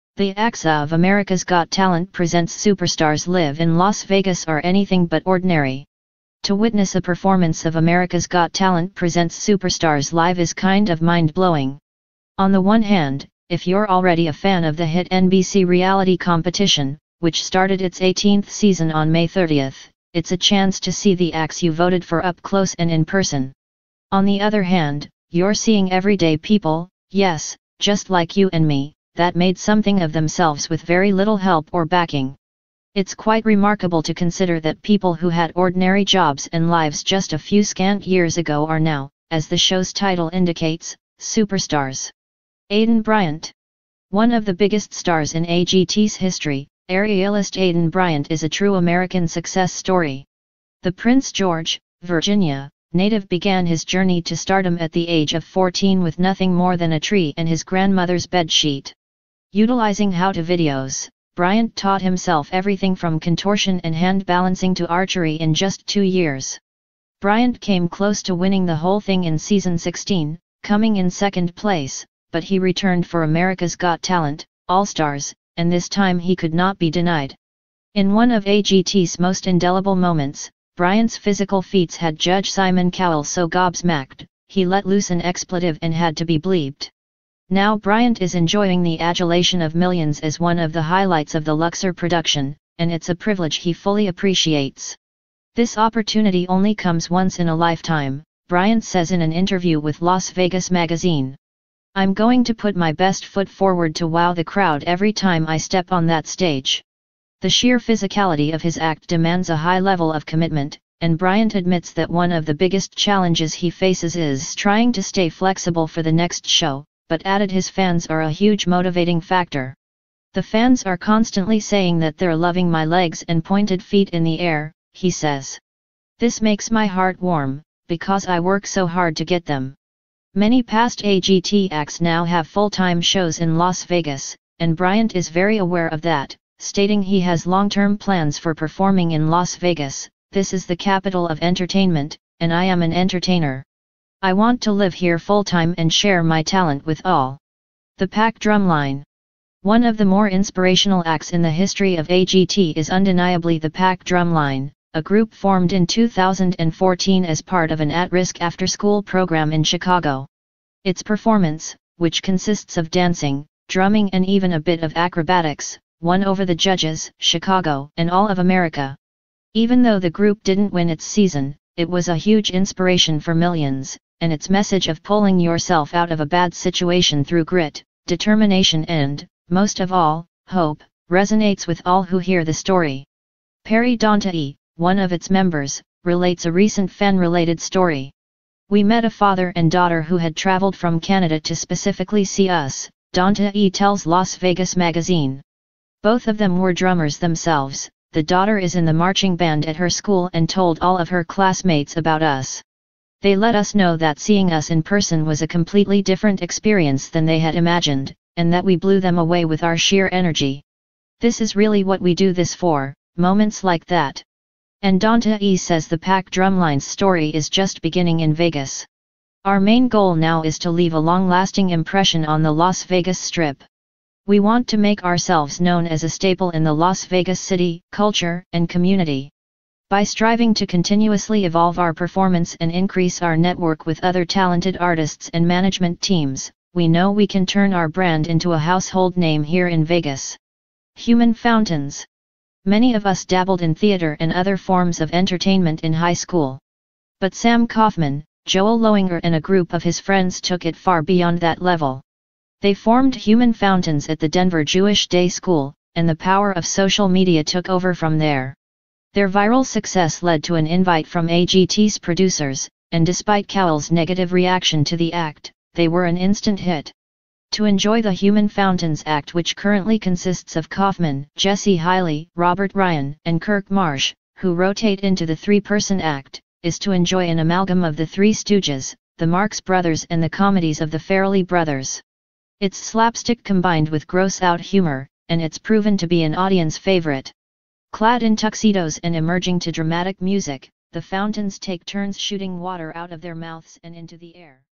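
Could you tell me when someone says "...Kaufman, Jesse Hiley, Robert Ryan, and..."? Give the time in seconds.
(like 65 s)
270 s.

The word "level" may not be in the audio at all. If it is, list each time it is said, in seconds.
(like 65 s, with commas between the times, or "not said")
109 s, 251 s.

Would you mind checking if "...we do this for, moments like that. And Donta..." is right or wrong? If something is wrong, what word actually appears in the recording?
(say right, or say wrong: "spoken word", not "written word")
right.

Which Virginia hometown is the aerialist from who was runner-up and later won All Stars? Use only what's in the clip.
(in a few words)
Prince George.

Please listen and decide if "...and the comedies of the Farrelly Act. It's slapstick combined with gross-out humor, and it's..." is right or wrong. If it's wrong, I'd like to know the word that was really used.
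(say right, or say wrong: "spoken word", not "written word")
wrong: "Brothers", not "Act".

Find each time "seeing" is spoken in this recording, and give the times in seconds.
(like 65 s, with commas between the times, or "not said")
25 s, 204 s.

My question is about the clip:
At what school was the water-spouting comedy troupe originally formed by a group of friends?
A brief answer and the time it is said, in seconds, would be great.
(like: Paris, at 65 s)
Denver Jewish Day School, at 254 s.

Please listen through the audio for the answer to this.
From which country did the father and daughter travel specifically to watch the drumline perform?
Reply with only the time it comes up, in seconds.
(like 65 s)
190 s.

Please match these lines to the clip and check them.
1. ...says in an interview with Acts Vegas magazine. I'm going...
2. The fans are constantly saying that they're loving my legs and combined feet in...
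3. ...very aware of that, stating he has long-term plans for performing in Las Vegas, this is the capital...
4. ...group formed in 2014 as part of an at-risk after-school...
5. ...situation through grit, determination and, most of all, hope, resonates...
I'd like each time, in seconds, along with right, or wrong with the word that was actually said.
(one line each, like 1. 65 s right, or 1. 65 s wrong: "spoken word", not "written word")
1. 98 s wrong: "Las", not "Acts"
2. 120 s wrong: "pointed", not "combined"
3. 135 s right
4. 155 s right
5. 176 s right.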